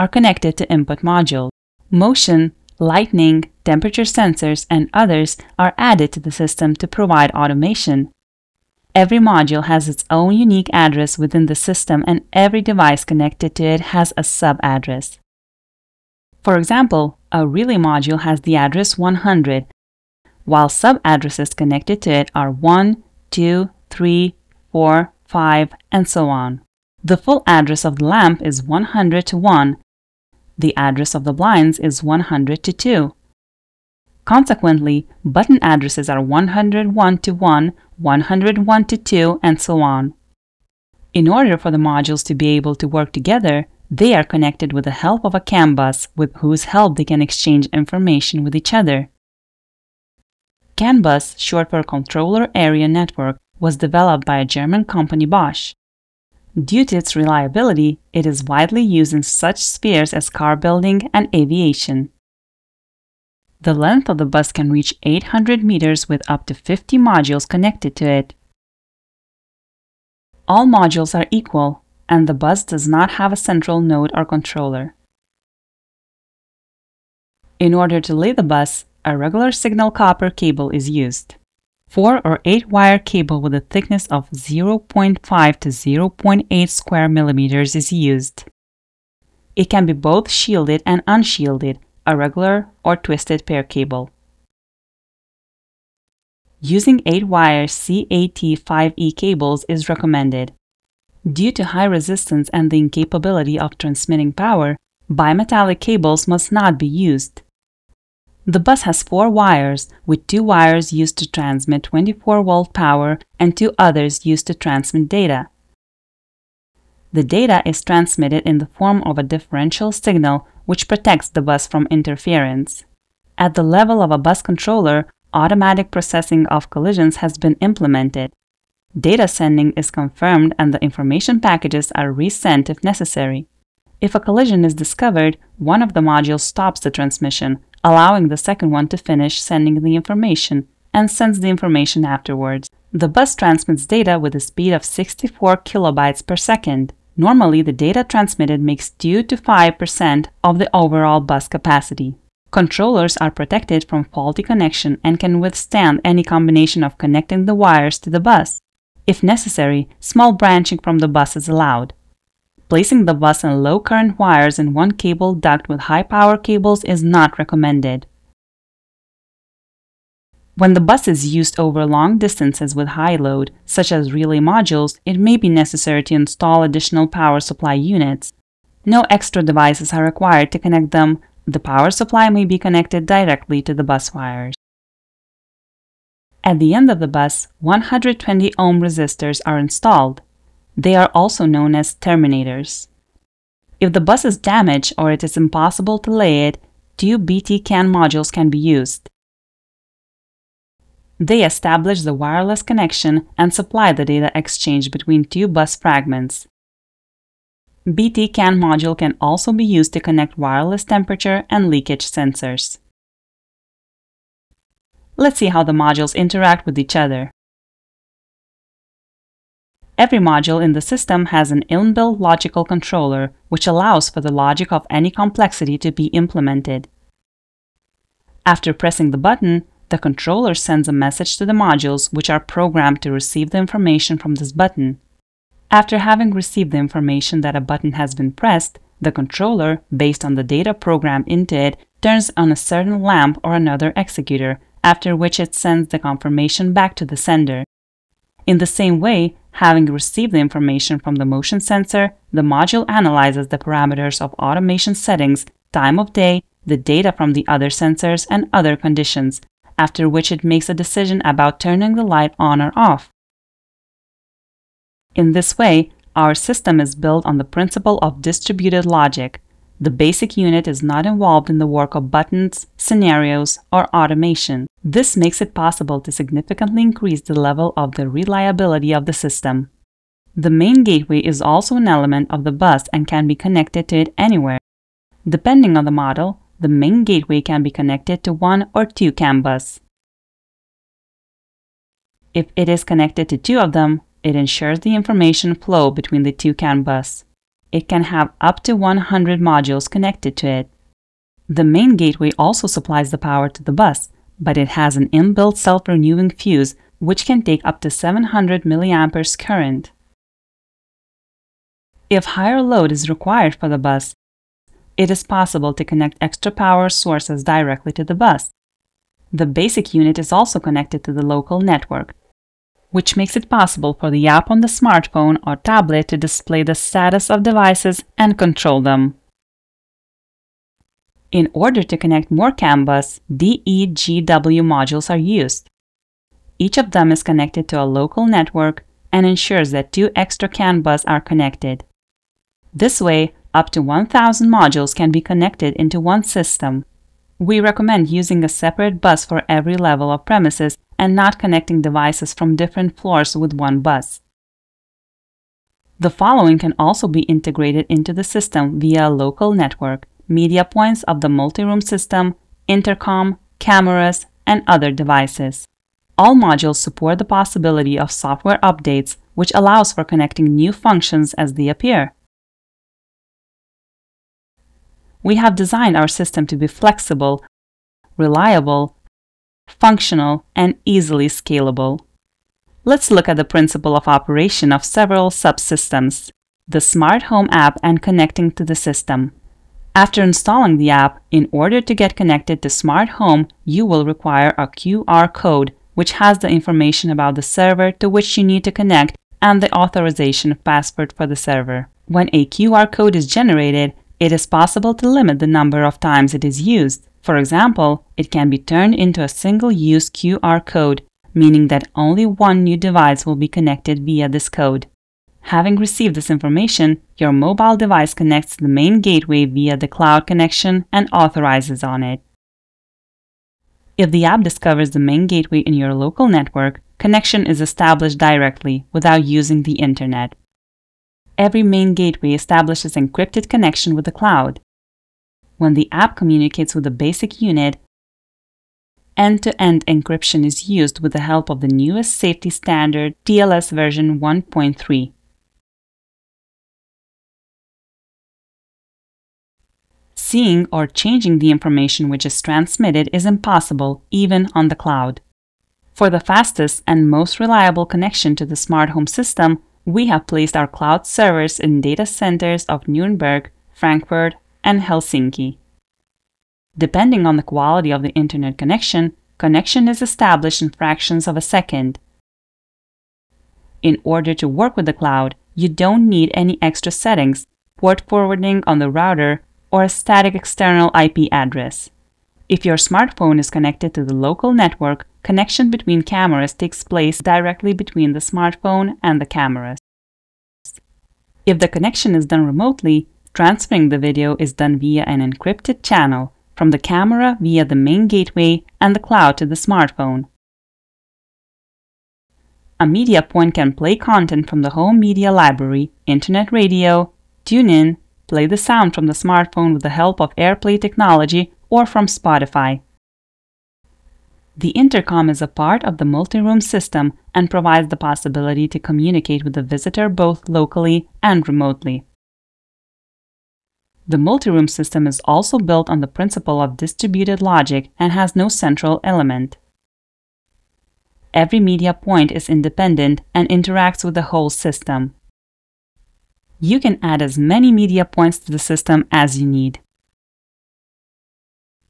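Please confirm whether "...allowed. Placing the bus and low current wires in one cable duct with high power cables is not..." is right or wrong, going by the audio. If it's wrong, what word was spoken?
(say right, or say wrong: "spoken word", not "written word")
right.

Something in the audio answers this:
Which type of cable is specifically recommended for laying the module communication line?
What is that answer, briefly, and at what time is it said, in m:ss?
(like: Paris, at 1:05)
8-wire CAT5E, at 1:37.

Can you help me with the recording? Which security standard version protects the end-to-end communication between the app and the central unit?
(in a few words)
TLS 1.3.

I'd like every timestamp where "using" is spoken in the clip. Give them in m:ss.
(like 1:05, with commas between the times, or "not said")
1:36, 5:48, 7:09.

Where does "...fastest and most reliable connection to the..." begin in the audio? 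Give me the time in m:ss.
7:36.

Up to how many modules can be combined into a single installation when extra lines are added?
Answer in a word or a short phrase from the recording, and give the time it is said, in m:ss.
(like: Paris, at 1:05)
1,000, at 5:43.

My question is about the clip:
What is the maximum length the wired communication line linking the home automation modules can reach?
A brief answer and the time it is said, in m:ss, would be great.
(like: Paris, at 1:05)
800 meters, at 1:05.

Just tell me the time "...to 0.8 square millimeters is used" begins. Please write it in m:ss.
1:25.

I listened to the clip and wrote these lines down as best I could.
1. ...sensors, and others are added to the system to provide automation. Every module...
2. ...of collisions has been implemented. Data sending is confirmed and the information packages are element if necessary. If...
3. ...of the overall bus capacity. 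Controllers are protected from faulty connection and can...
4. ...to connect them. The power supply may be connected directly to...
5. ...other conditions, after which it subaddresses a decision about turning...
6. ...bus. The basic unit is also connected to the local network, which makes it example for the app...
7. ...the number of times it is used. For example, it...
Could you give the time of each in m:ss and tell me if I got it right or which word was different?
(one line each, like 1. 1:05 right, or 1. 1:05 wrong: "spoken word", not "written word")
1. 0:04 right
2. 2:06 wrong: "resent", not "element"
3. 2:30 right
4. 3:00 right
5. 4:18 wrong: "makes", not "subaddresses"
6. 5:18 wrong: "possible", not "example"
7. 6:45 right.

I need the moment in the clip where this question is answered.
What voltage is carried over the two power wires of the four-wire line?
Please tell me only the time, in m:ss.
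1:51.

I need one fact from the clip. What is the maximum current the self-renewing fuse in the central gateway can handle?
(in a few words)
700 milliamperes.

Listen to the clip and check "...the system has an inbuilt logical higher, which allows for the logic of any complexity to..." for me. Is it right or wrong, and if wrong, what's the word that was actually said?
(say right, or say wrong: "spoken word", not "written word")
wrong: "controller", not "higher".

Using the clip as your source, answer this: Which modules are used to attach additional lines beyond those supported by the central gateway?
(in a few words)
DEGW modules.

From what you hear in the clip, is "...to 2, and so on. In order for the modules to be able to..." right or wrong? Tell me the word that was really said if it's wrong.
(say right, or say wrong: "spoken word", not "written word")
right.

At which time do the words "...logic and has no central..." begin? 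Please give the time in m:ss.
8:47.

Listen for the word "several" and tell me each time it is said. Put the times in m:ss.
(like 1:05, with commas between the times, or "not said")
6:24.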